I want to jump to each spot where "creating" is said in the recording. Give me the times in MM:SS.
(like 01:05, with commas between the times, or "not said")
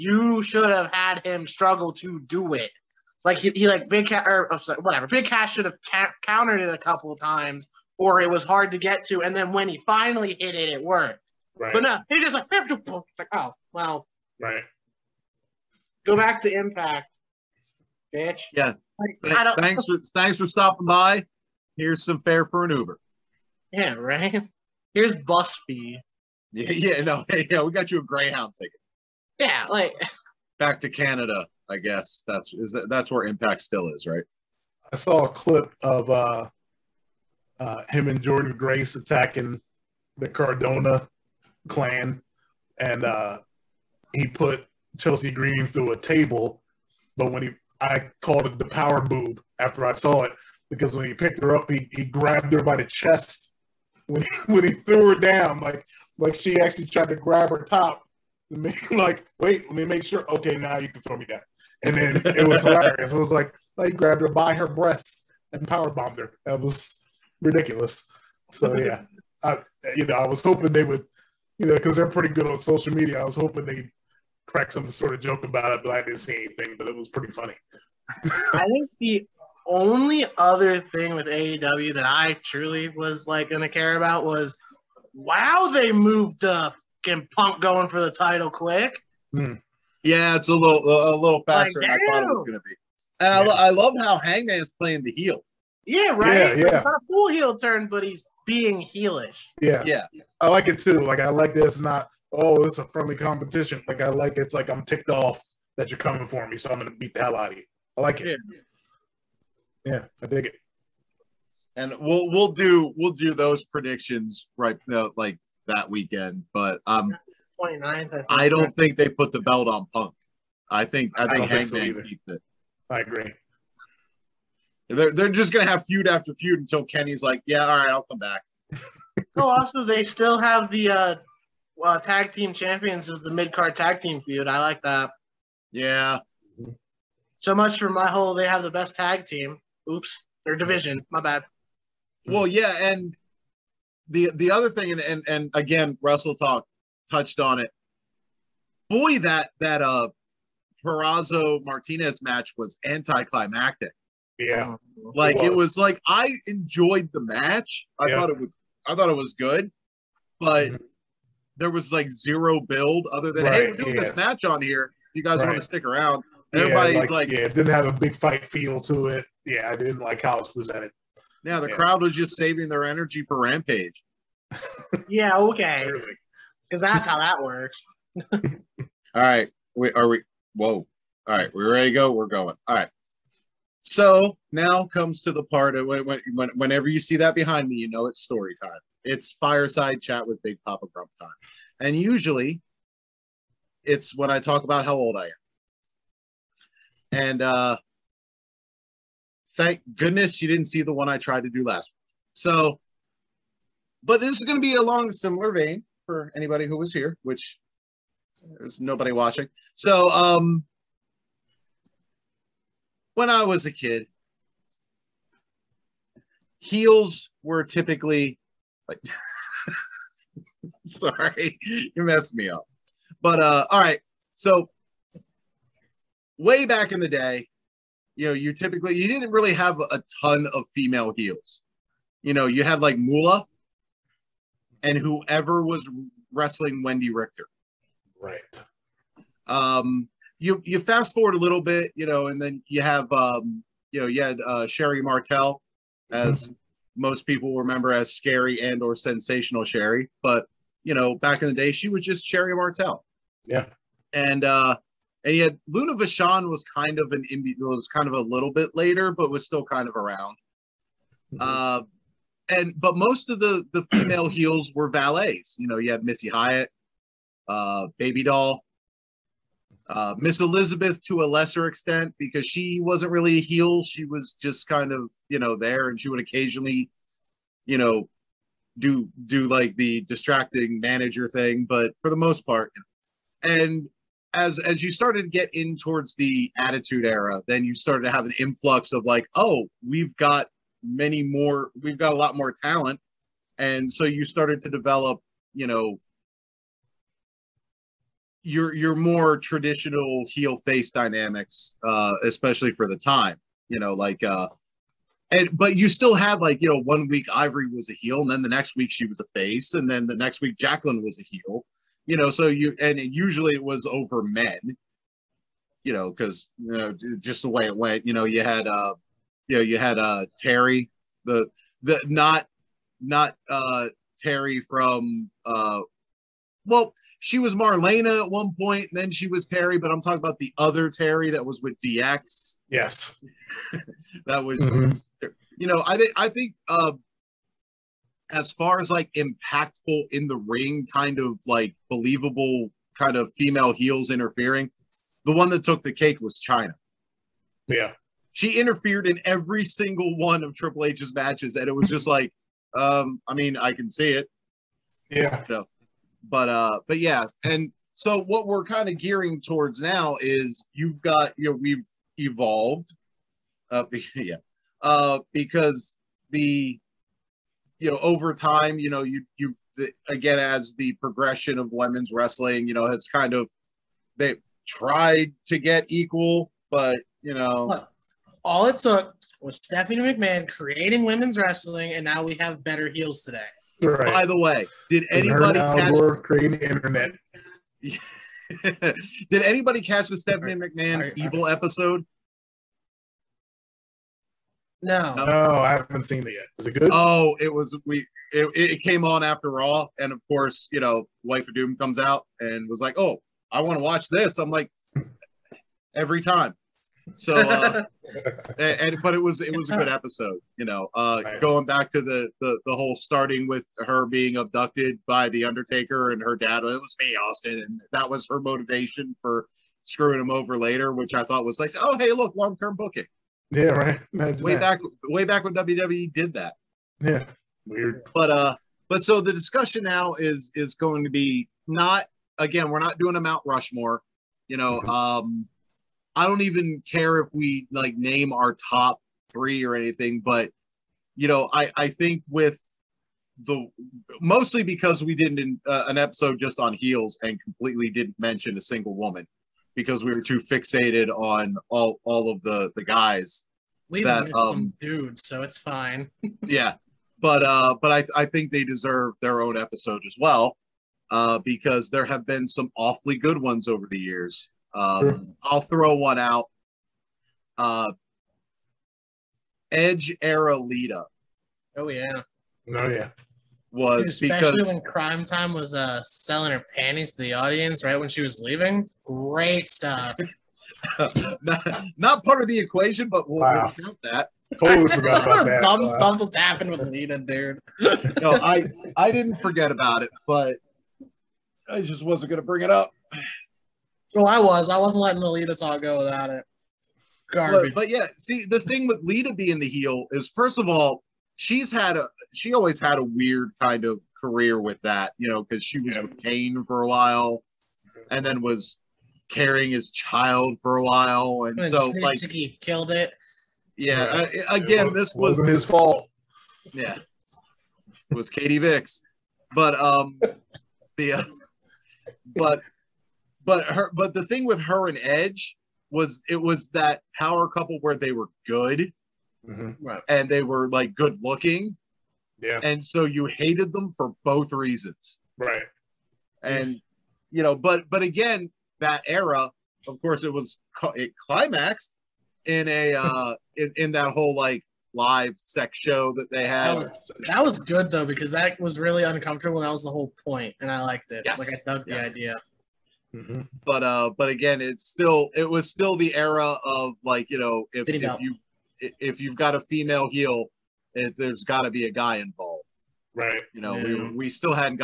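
06:20, 06:26.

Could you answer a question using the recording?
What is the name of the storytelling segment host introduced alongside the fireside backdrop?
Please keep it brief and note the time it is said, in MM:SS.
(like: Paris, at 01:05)
Big Papa Grump, at 03:10.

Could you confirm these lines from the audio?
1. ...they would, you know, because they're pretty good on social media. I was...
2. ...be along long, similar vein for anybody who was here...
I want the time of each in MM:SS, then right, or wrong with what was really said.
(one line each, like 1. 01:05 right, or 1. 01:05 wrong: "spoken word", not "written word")
1. 01:10 right
2. 03:24 right.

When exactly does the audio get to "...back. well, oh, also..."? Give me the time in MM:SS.
02:08.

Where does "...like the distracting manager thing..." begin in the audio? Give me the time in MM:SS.
04:39.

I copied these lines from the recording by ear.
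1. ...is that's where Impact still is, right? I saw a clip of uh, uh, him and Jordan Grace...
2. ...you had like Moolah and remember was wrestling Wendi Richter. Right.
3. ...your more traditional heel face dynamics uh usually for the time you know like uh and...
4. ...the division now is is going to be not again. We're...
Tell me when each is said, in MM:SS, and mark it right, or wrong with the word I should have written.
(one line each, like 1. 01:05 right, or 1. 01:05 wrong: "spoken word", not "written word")
1. 00:32 right
2. 03:52 wrong: "whoever", not "remember"
3. 04:58 wrong: "especially", not "usually"
4. 07:09 wrong: "discussion", not "division".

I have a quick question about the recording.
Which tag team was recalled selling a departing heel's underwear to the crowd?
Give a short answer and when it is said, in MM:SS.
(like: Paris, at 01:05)
Cryme Tyme, at 07:54.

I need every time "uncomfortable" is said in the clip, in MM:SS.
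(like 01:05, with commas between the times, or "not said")
09:09.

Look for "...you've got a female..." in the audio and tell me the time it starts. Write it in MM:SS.
09:19.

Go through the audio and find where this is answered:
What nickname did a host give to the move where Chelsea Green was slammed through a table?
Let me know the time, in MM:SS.
00:48.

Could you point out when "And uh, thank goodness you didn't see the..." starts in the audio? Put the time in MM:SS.
03:17.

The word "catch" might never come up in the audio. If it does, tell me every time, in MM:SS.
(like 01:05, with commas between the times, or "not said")
06:25, 06:29.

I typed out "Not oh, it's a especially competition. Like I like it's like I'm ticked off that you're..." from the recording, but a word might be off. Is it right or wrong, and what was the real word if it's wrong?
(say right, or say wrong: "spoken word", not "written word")
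wrong: "friendly", not "especially".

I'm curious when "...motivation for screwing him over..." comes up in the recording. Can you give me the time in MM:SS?
06:58.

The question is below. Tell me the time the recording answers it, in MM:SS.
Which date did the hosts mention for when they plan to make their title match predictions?
01:57.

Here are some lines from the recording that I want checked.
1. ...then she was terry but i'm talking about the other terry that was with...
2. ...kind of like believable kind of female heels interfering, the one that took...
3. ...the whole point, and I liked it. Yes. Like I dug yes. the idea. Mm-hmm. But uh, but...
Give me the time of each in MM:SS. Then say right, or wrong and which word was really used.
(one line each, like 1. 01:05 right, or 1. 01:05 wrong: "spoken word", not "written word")
1. 05:28 right
2. 05:40 right
3. 09:09 right.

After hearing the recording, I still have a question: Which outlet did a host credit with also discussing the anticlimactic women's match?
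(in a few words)
Wrestle Talk.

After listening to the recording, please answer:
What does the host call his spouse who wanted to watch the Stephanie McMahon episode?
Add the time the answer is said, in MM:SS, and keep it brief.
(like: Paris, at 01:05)
Wife of Doom, at 06:41.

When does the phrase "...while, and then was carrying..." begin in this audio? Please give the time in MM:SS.
08:26.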